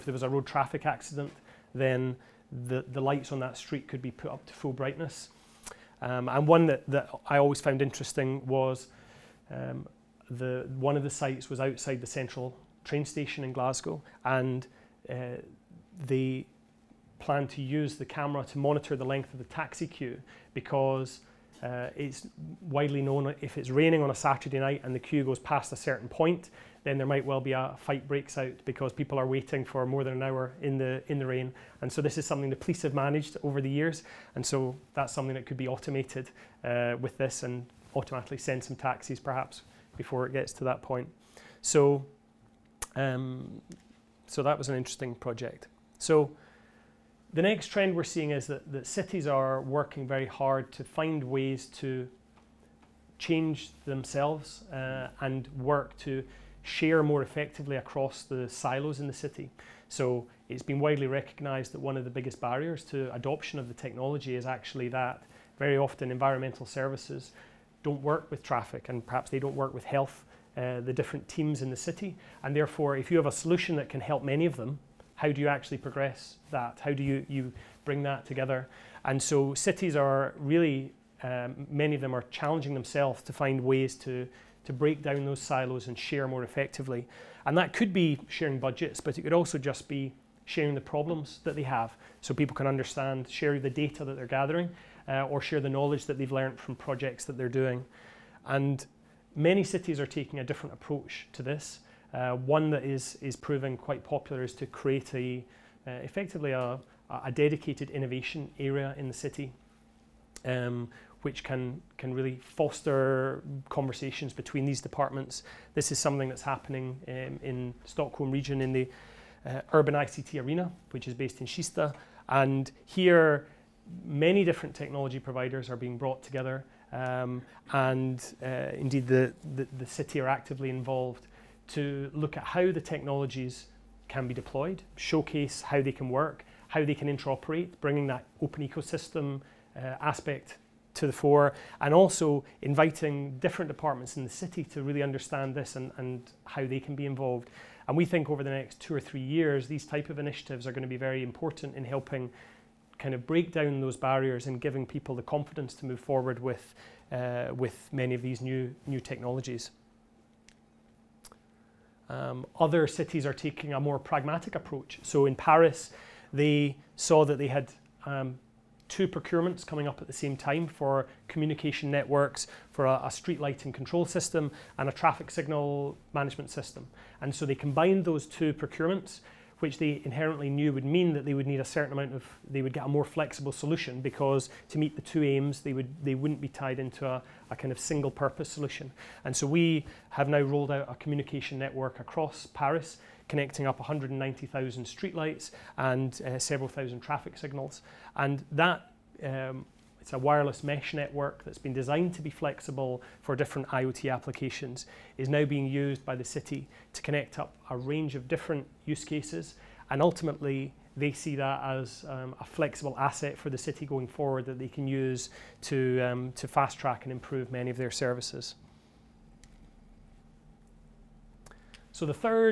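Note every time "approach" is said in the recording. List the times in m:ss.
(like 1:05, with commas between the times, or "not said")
1:40, 2:44.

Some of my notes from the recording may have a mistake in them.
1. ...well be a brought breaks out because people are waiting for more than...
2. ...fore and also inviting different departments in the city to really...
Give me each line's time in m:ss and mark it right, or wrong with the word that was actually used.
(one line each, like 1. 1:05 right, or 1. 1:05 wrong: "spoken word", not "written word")
1. 0:27 wrong: "fight", not "brought"
2. 2:21 right.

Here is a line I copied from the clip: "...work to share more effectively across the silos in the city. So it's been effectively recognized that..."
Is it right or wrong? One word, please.
wrong.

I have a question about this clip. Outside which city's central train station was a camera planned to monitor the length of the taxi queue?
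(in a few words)
Glasgow.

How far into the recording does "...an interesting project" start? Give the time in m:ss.
0:44.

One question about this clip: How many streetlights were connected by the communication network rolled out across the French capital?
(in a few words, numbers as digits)
190,000.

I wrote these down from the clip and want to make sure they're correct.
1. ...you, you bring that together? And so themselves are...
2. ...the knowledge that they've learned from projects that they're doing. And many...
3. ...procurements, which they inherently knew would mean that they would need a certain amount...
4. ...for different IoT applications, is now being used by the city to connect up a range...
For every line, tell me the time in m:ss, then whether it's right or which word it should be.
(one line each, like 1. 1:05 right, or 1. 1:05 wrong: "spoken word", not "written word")
1. 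1:17 wrong: "cities", not "themselves"
2. 1:35 right
3. 2:58 right
4. 3:23 right.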